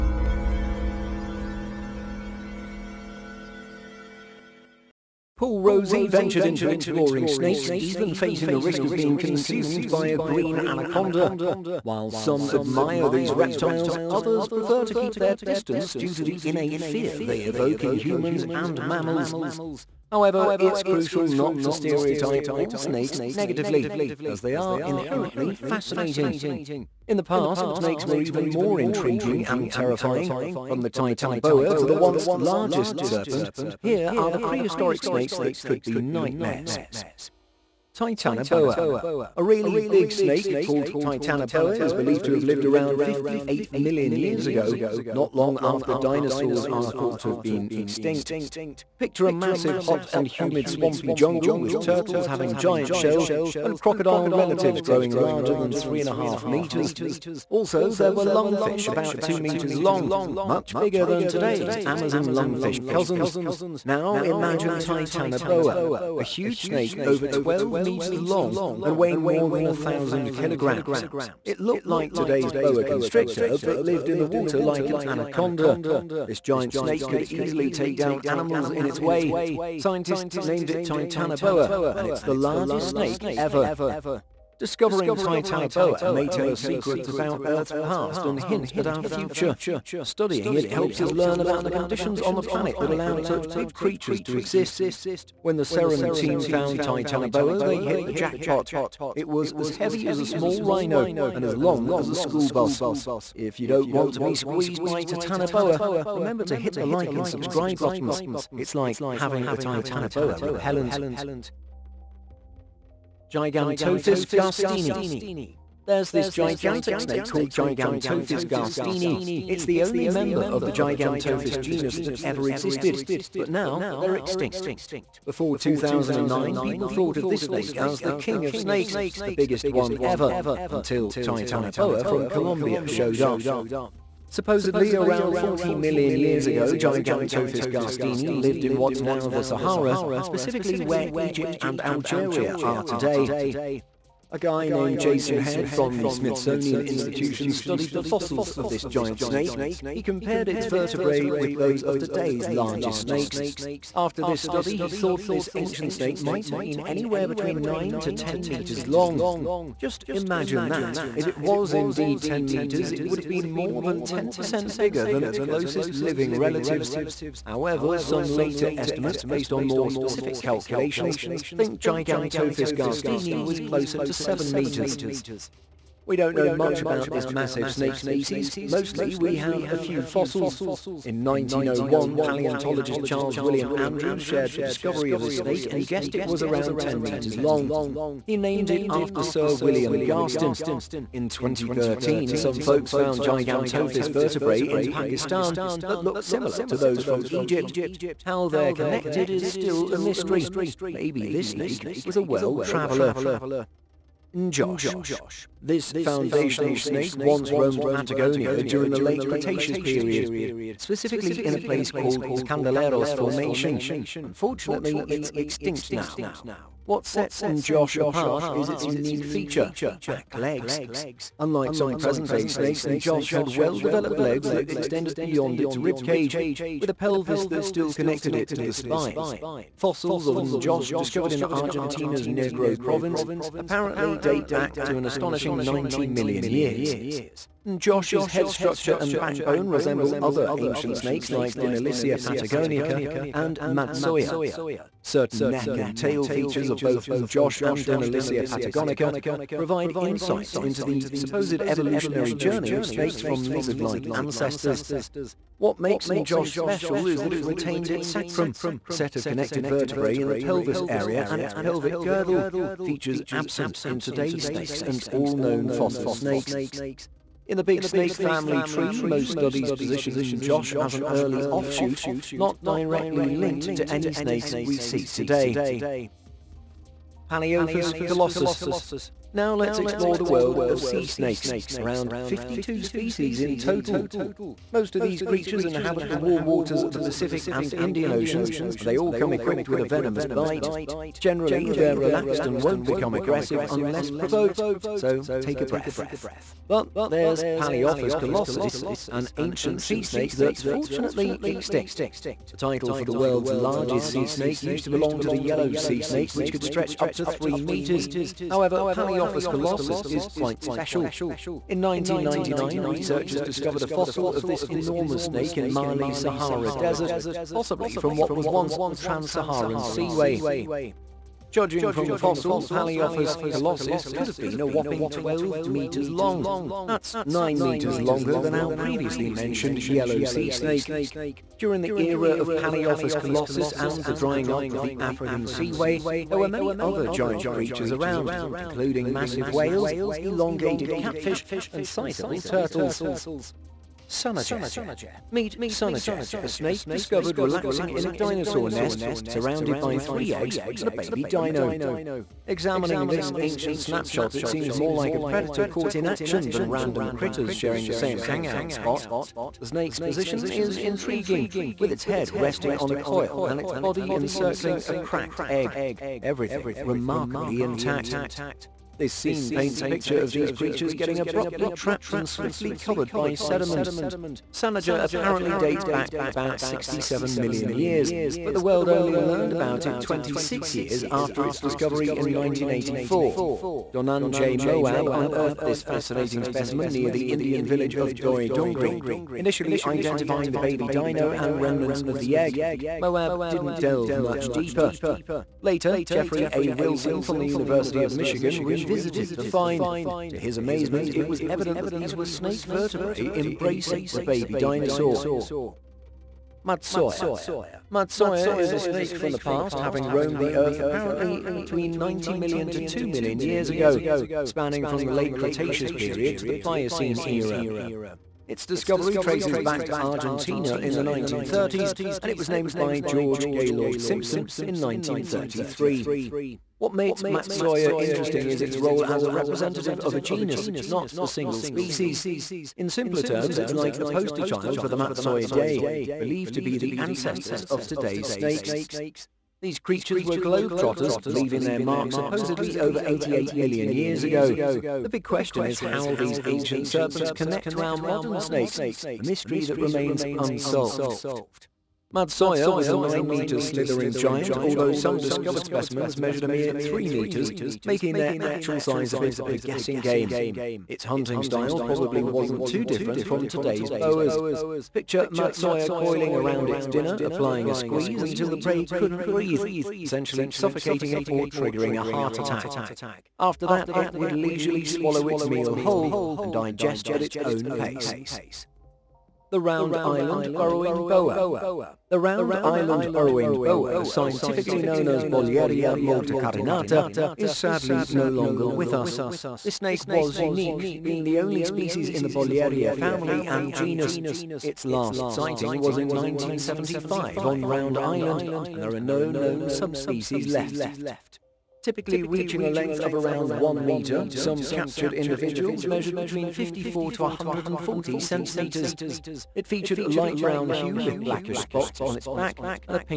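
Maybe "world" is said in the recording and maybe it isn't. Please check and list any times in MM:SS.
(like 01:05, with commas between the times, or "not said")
03:22, 04:40, 05:03, 06:18.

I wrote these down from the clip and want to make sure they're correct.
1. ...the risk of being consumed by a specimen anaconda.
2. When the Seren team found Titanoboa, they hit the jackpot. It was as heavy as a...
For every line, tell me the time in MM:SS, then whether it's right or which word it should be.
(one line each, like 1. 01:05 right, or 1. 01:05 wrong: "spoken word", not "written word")
1. 00:08 wrong: "green", not "specimen"
2. 01:35 right.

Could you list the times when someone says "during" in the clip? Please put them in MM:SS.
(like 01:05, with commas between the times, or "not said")
03:28, 05:31.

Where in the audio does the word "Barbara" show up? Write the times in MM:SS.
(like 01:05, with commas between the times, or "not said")
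not said.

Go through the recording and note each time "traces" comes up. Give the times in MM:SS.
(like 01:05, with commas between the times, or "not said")
06:59.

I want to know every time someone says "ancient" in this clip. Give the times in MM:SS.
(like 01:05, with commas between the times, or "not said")
02:35, 04:00, 04:59, 05:53, 07:26.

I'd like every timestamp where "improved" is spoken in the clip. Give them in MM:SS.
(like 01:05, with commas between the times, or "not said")
not said.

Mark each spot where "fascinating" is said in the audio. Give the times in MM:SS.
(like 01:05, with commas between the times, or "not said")
00:25, 06:25.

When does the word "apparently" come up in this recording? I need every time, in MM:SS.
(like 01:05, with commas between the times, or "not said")
03:53, 06:15, 06:50.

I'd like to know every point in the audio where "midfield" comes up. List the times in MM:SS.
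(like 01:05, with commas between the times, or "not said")
not said.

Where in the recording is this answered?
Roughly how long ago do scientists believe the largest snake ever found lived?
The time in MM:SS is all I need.
00:43.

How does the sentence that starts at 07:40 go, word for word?
Its hunting style probably wasn't too different from today's boas.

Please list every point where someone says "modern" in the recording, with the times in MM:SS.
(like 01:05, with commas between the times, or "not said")
07:27.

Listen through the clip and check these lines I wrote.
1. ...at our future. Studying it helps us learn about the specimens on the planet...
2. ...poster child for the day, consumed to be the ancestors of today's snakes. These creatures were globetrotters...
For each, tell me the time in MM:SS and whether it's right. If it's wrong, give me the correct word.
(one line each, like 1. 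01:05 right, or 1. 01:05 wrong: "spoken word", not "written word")
1. 01:28 wrong: "conditions", not "specimens"
2. 07:14 wrong: "believed", not "consumed".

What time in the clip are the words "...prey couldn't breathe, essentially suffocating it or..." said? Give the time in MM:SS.
07:48.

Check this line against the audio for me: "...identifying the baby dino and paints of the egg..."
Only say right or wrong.
wrong.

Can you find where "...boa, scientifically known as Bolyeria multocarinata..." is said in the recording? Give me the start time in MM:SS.
08:03.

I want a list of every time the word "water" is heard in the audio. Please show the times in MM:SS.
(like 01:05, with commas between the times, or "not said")
01:14, 04:46.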